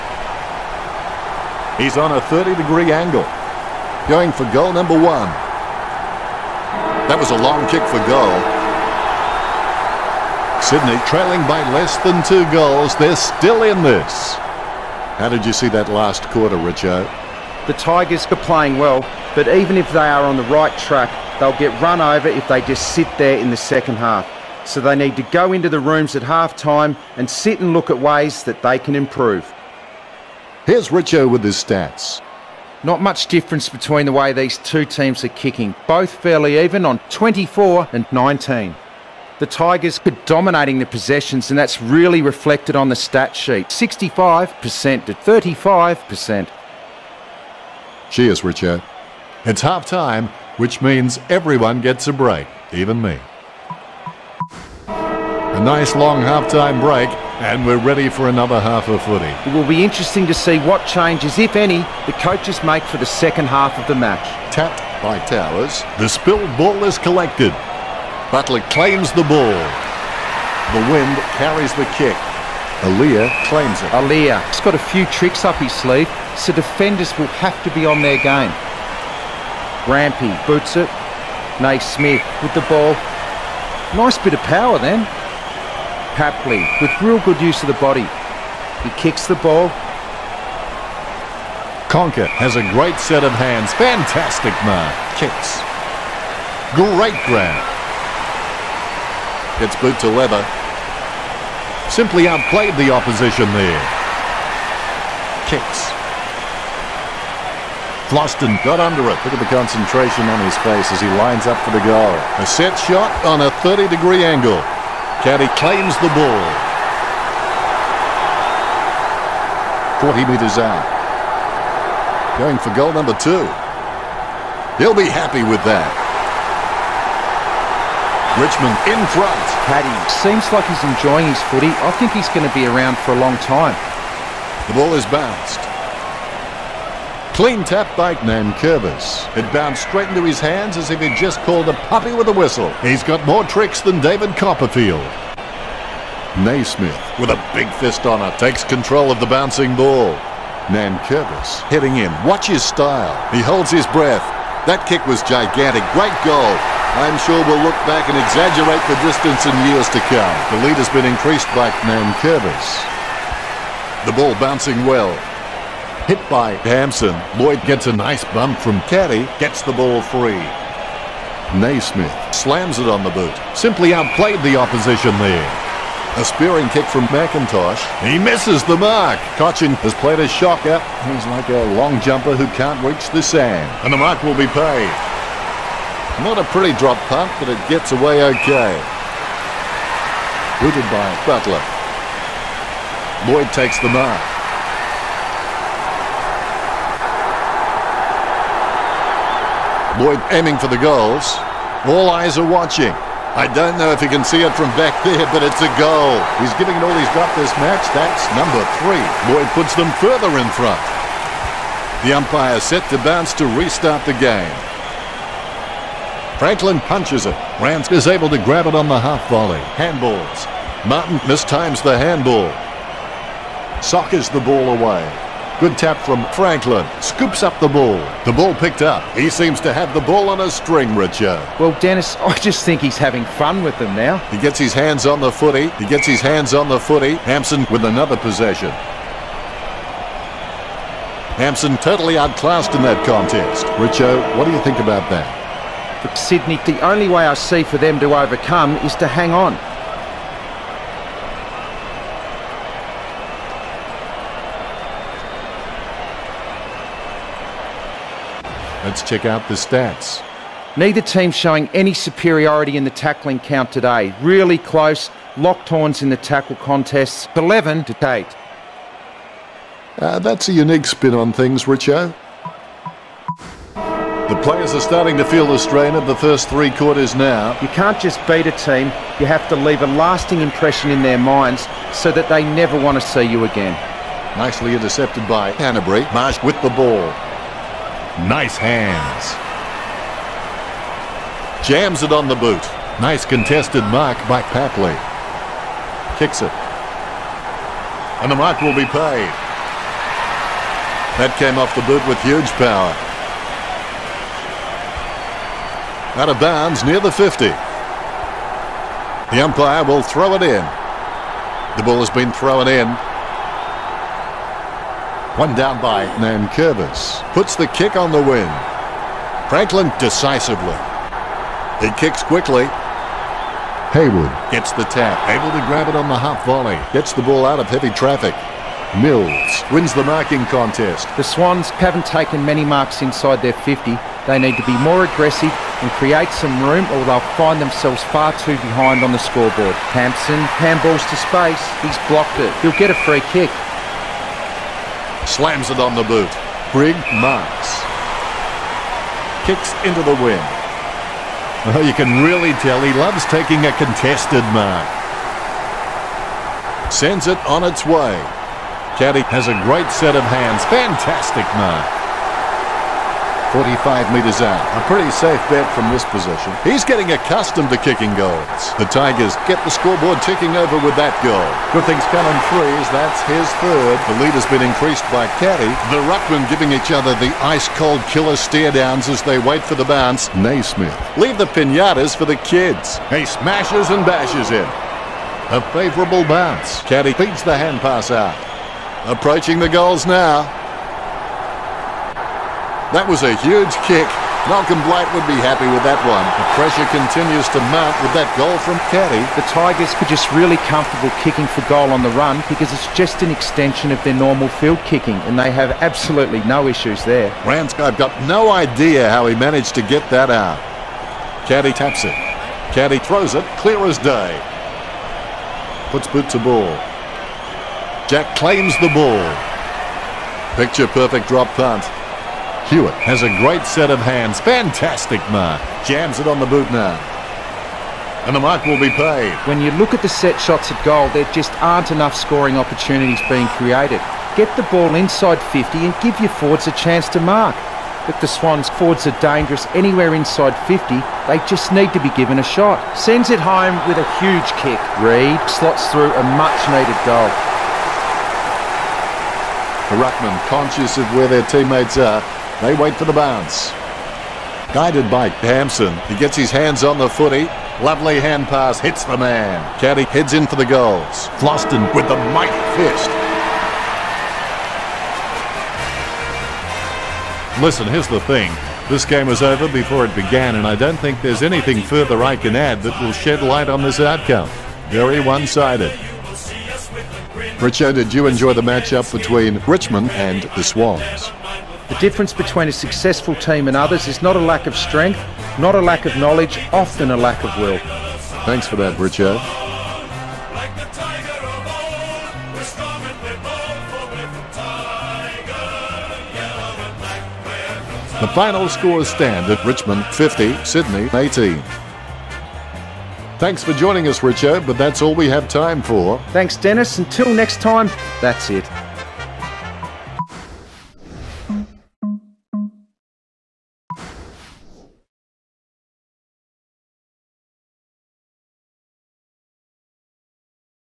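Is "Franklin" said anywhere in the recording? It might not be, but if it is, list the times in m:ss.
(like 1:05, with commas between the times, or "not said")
3:36, 3:46, 5:19.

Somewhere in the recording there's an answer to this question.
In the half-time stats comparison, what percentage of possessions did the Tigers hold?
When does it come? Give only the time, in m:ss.
0:43.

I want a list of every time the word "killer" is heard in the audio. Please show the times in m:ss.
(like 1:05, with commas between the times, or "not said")
6:18.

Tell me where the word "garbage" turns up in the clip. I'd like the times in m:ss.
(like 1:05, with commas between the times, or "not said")
not said.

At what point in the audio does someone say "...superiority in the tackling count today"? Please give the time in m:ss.
4:21.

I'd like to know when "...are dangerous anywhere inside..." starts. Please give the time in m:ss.
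7:19.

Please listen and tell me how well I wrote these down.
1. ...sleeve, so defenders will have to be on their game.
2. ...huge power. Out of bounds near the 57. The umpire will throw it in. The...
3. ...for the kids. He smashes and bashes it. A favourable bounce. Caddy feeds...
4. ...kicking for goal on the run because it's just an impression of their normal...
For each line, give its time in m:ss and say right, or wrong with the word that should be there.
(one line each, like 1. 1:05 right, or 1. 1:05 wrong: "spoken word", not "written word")
1. 1:15 right
2. 5:02 wrong: "50", not "57"
3. 6:22 right
4. 6:41 wrong: "extension", not "impression".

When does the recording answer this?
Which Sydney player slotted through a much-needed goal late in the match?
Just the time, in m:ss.
7:25.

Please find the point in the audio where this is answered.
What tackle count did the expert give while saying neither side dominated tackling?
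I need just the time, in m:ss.
4:27.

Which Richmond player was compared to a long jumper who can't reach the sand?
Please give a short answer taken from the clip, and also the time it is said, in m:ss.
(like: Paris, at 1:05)
Cotchin, at 2:59.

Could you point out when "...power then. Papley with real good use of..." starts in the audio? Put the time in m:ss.
1:24.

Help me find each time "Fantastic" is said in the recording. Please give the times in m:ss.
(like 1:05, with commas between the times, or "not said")
1:33, 6:00, 7:04.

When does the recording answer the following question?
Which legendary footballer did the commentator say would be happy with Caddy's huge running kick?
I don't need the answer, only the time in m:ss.
6:34.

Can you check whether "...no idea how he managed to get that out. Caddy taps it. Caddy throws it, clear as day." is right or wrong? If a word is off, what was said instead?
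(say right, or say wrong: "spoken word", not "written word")
right.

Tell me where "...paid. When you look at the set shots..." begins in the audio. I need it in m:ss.
7:08.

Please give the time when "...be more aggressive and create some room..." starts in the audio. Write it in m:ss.
5:34.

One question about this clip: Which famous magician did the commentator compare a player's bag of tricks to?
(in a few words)
David Copperfield.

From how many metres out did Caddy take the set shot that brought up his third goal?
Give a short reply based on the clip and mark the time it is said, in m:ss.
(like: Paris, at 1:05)
45, at 6:03.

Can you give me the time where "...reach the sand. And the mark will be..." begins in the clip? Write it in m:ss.
3:02.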